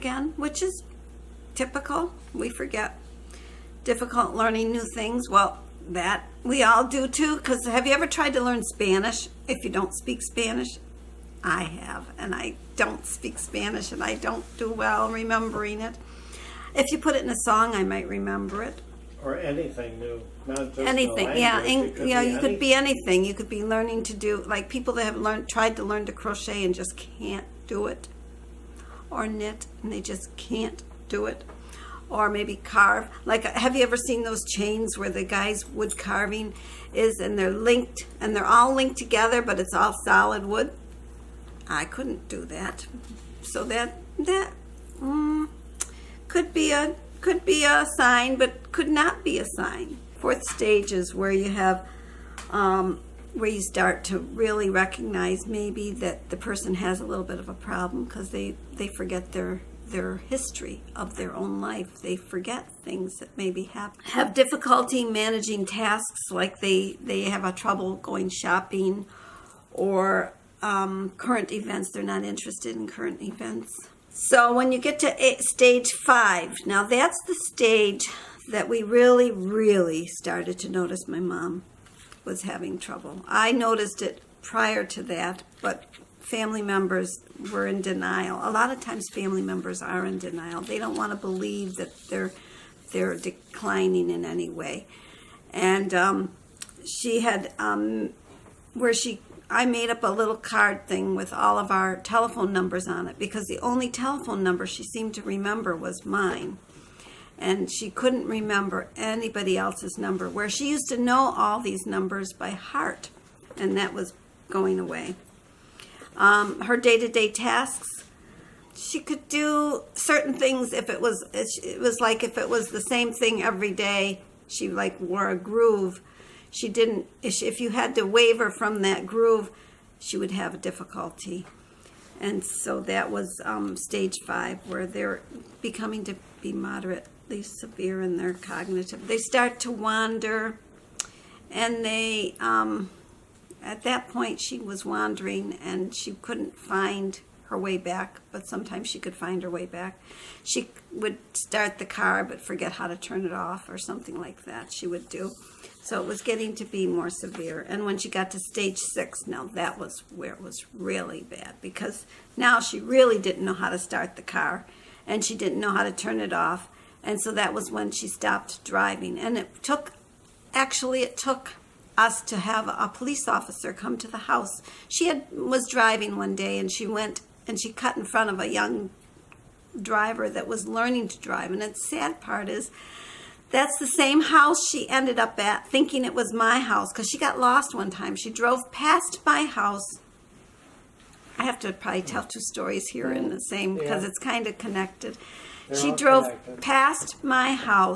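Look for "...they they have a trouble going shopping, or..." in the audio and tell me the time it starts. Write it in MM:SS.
01:06.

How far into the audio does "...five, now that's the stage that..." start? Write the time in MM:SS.
01:15.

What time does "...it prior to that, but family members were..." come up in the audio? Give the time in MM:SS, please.
01:24.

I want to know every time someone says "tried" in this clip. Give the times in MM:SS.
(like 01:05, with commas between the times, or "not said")
00:08, 00:25.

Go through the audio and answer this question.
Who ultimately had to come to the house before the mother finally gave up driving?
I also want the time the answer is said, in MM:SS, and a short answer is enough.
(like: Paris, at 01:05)
a police officer, at 02:52.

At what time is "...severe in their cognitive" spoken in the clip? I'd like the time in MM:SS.
02:17.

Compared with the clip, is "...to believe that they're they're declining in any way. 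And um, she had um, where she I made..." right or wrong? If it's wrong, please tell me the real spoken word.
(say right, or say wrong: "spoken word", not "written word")
right.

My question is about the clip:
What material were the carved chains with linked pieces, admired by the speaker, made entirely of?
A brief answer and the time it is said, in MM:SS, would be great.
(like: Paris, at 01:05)
solid wood, at 00:40.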